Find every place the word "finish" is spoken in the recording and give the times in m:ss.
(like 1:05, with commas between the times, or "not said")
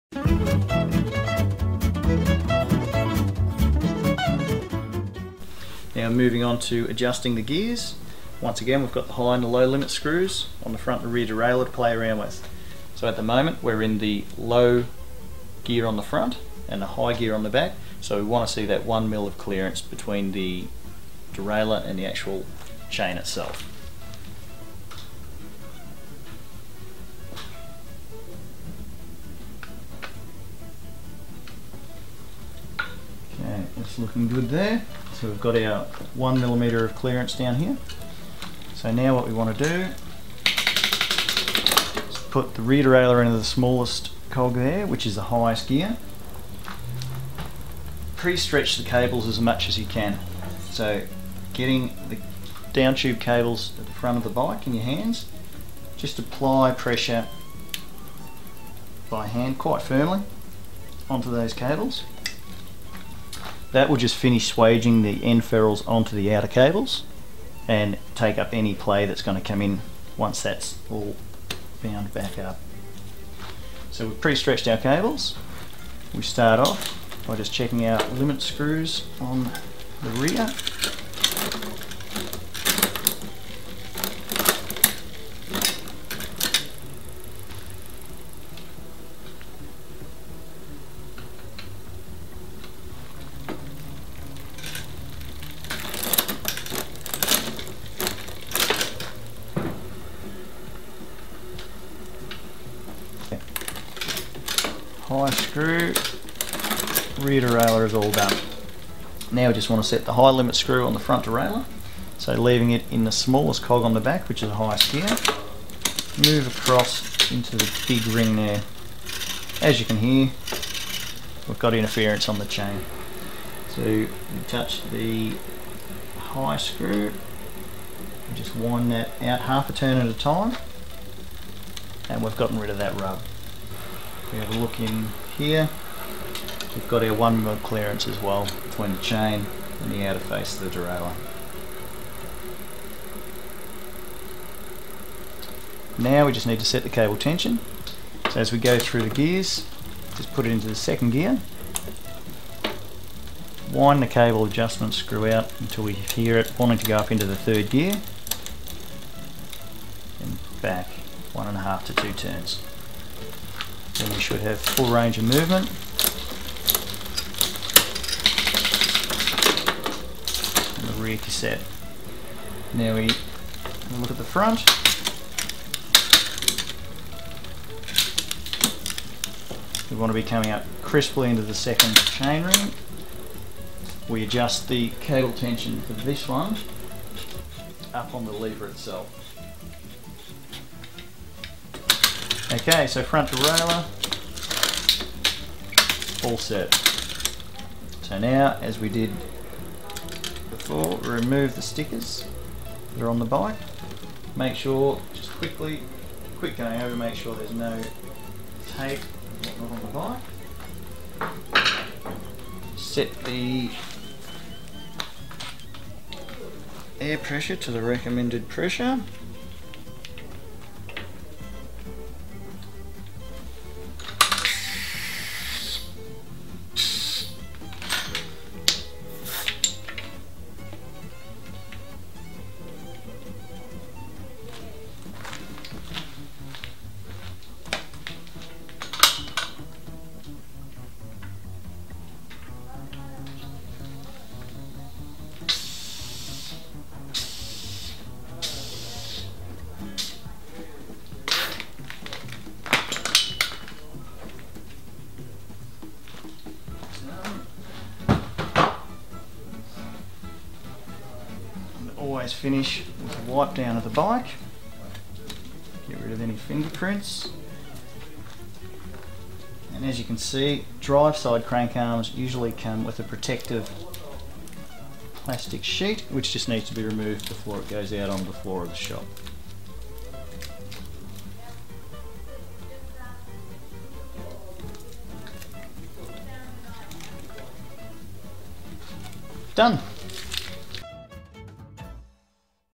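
1:04, 4:22.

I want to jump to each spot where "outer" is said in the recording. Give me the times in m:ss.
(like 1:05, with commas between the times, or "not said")
1:06, 2:20.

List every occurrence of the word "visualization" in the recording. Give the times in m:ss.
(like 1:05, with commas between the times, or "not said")
not said.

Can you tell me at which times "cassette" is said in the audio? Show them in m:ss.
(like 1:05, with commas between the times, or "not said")
2:51.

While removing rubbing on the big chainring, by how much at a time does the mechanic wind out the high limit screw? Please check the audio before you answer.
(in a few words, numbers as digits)
half a turn.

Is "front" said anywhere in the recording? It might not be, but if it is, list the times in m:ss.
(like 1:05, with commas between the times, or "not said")
0:10, 0:16, 0:53, 1:51, 2:54, 3:13.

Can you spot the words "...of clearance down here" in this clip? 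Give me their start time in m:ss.
0:36.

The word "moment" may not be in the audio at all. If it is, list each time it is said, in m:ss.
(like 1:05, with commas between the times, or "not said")
0:13.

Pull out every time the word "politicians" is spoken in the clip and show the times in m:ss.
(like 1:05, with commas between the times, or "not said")
not said.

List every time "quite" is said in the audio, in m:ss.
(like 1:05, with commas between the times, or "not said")
0:59.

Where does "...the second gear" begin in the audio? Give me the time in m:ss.
2:30.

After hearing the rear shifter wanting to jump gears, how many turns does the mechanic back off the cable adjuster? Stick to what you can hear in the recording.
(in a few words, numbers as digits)
1.5 to 2 turns.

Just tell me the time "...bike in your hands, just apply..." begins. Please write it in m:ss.
0:54.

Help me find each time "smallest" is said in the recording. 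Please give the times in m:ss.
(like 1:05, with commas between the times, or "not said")
0:43, 1:53.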